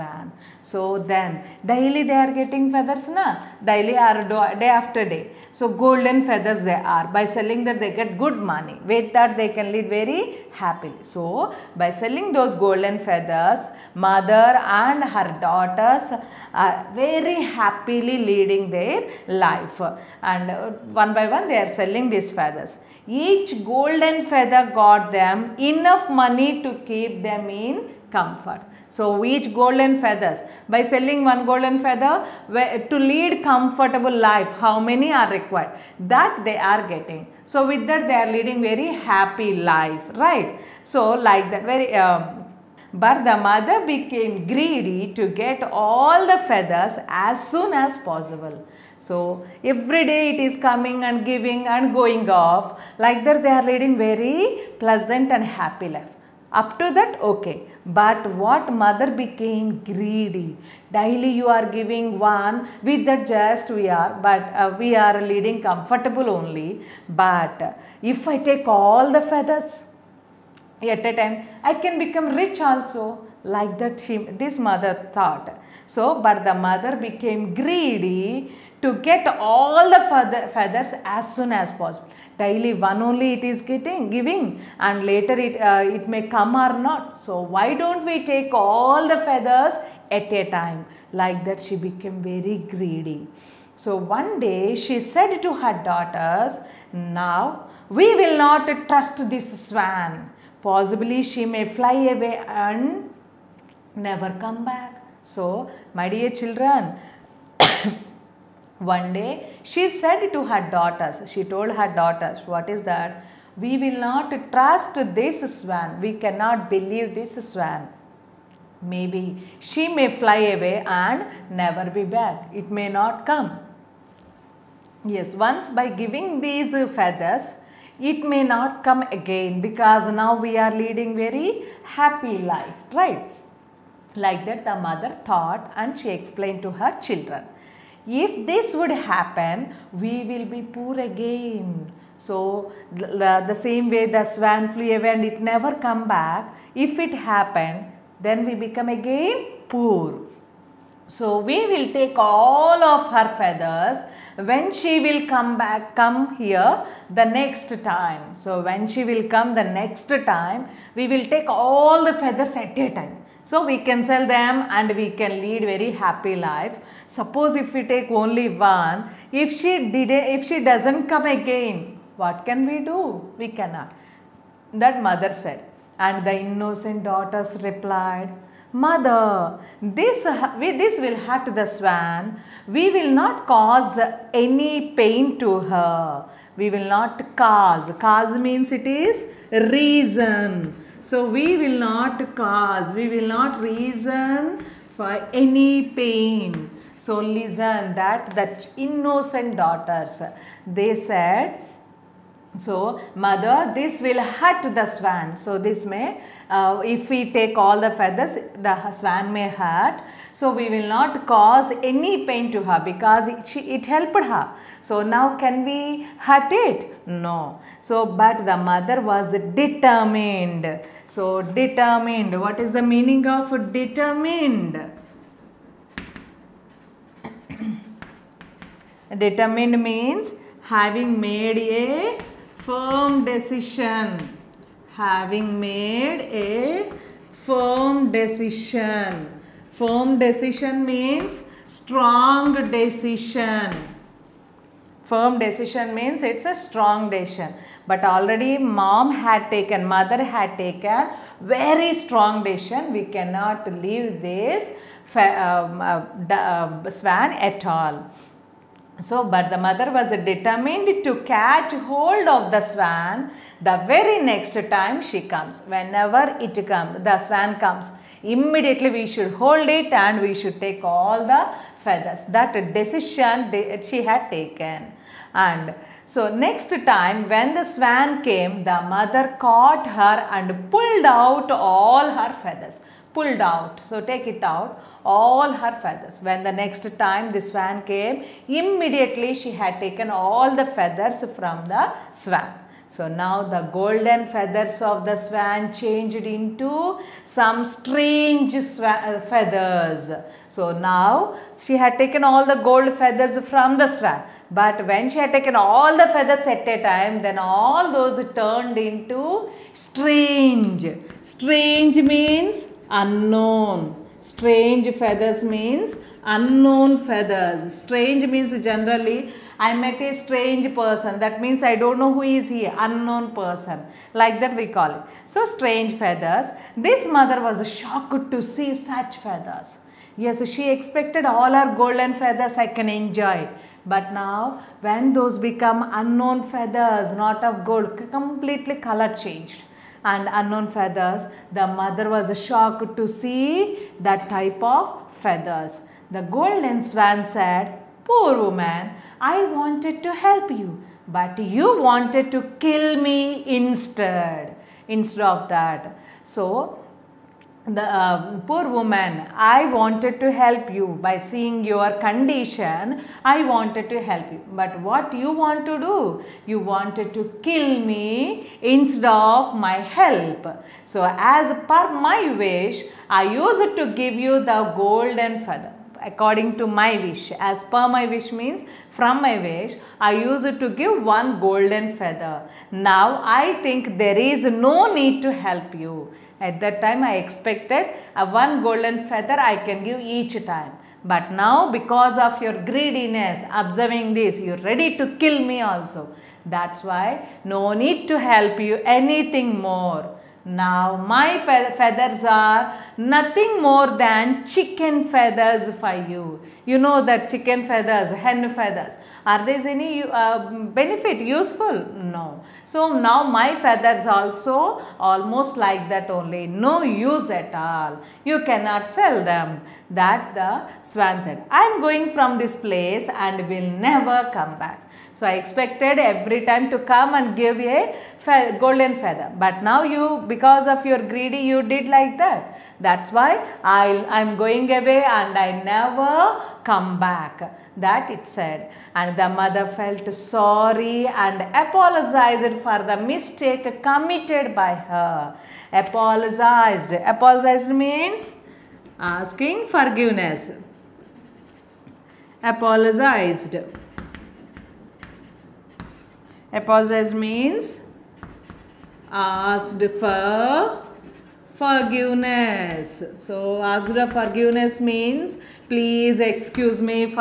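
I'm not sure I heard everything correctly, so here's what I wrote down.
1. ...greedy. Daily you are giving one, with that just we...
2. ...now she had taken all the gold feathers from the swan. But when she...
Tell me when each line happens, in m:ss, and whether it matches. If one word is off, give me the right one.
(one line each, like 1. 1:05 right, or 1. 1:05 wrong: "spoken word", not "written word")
1. 0:59 right
2. 5:00 right.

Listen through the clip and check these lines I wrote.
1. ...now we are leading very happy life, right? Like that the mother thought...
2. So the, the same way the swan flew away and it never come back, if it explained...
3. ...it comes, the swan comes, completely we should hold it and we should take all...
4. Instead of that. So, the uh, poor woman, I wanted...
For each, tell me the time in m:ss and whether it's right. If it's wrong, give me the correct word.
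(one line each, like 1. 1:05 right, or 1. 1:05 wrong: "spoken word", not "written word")
1. 2:10 right
2. 2:22 wrong: "happened", not "explained"
3. 4:26 wrong: "immediately", not "completely"
4. 5:54 right.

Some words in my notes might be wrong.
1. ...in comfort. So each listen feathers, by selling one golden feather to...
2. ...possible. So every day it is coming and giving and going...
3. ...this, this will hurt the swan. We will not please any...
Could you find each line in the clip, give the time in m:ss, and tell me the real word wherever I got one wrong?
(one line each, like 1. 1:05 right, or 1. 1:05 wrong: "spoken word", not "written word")
1. 0:27 wrong: "golden", not "listen"
2. 0:47 right
3. 2:59 wrong: "cause", not "please".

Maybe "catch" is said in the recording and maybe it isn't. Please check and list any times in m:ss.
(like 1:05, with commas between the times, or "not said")
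4:21.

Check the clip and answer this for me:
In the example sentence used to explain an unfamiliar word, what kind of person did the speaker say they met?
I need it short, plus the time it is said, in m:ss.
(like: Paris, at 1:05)
A strange person, at 5:20.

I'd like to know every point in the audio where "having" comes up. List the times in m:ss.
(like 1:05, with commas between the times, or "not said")
3:50, 3:54.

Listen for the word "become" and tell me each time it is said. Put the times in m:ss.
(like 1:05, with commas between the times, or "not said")
1:11, 2:28, 5:35.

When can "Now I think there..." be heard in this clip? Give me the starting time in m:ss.
6:22.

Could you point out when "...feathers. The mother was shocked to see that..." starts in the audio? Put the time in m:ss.
5:40.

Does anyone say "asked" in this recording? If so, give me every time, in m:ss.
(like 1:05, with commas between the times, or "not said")
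7:39.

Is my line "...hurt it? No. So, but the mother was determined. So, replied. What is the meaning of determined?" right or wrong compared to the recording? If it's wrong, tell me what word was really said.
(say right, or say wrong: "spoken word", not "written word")
wrong: "determined", not "replied".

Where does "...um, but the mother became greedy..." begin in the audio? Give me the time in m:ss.
0:41.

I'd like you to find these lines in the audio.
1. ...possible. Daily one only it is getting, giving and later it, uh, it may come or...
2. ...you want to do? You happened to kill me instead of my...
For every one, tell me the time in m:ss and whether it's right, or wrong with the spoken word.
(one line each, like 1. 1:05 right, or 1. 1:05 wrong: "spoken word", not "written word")
1. 1:21 right
2. 6:05 wrong: "wanted", not "happened".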